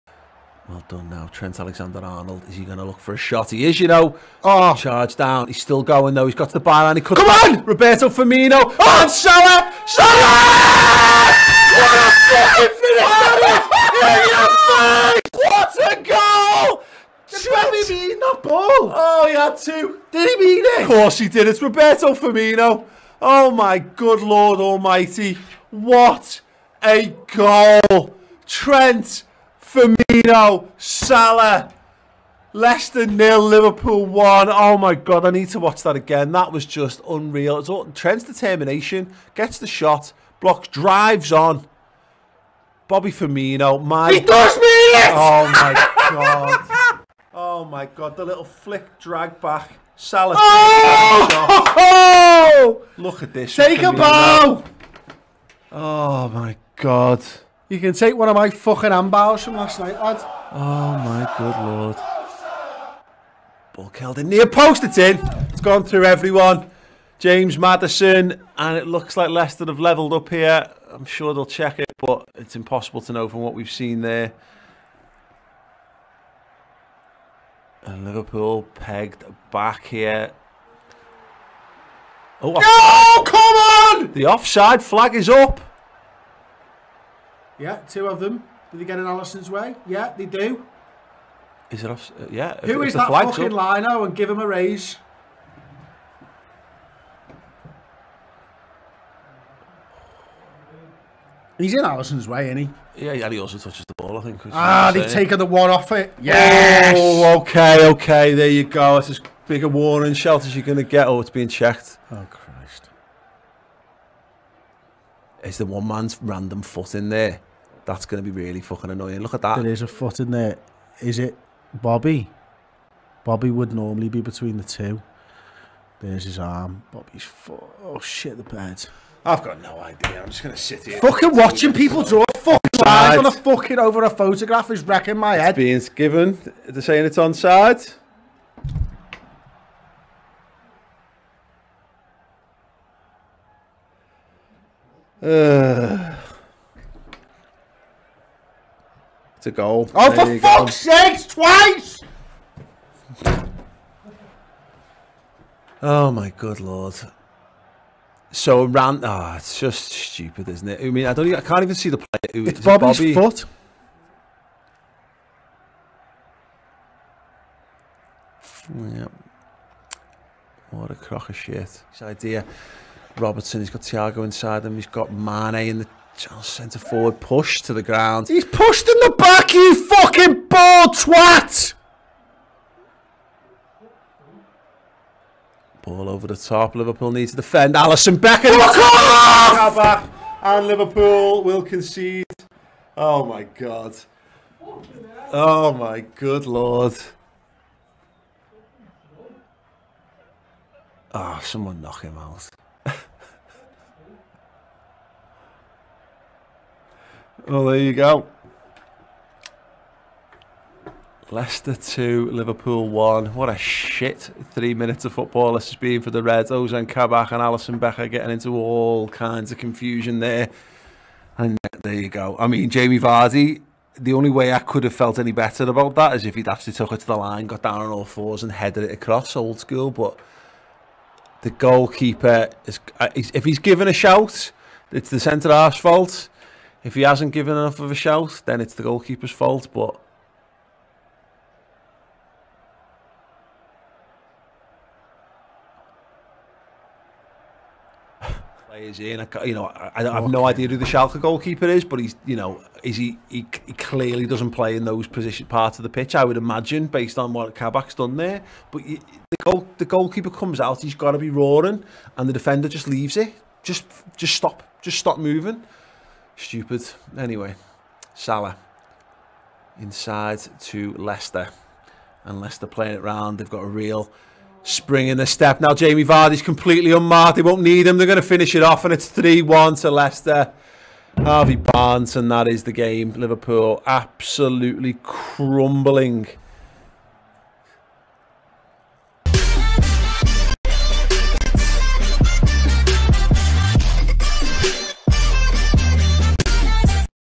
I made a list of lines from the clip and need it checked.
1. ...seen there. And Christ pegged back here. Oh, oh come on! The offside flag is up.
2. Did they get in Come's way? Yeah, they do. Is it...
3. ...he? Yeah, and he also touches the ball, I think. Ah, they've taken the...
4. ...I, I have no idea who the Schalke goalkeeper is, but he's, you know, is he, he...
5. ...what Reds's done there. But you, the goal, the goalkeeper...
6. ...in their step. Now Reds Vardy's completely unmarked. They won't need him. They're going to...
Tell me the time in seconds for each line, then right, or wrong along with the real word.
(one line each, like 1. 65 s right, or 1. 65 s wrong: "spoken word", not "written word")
1. 73 s wrong: "Liverpool", not "Christ"
2. 88 s wrong: "Alisson", not "Come"
3. 102 s right
4. 249 s right
5. 257 s wrong: "Kabak", not "Reds"
6. 275 s wrong: "Jamie", not "Reds".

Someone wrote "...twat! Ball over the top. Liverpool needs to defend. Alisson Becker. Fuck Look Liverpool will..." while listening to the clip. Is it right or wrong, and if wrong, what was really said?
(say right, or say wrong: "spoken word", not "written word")
wrong: "And", not "Look".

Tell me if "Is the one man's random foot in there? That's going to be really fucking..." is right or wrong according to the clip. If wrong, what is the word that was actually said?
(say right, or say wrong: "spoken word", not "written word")
right.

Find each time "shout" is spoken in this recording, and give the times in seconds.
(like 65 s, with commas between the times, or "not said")
233 s, 237 s.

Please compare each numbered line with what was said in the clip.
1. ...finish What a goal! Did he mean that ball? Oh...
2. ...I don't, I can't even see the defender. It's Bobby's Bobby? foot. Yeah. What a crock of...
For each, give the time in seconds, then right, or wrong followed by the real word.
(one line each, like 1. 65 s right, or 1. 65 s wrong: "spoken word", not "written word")
1. 15 s right
2. 161 s wrong: "player", not "defender".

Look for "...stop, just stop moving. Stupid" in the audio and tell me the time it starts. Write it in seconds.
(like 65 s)
264 s.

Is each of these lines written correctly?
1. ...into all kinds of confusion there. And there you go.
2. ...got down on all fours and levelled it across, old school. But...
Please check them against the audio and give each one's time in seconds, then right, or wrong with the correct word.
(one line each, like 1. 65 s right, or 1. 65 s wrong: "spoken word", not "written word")
1. 218 s right
2. 227 s wrong: "headed", not "levelled".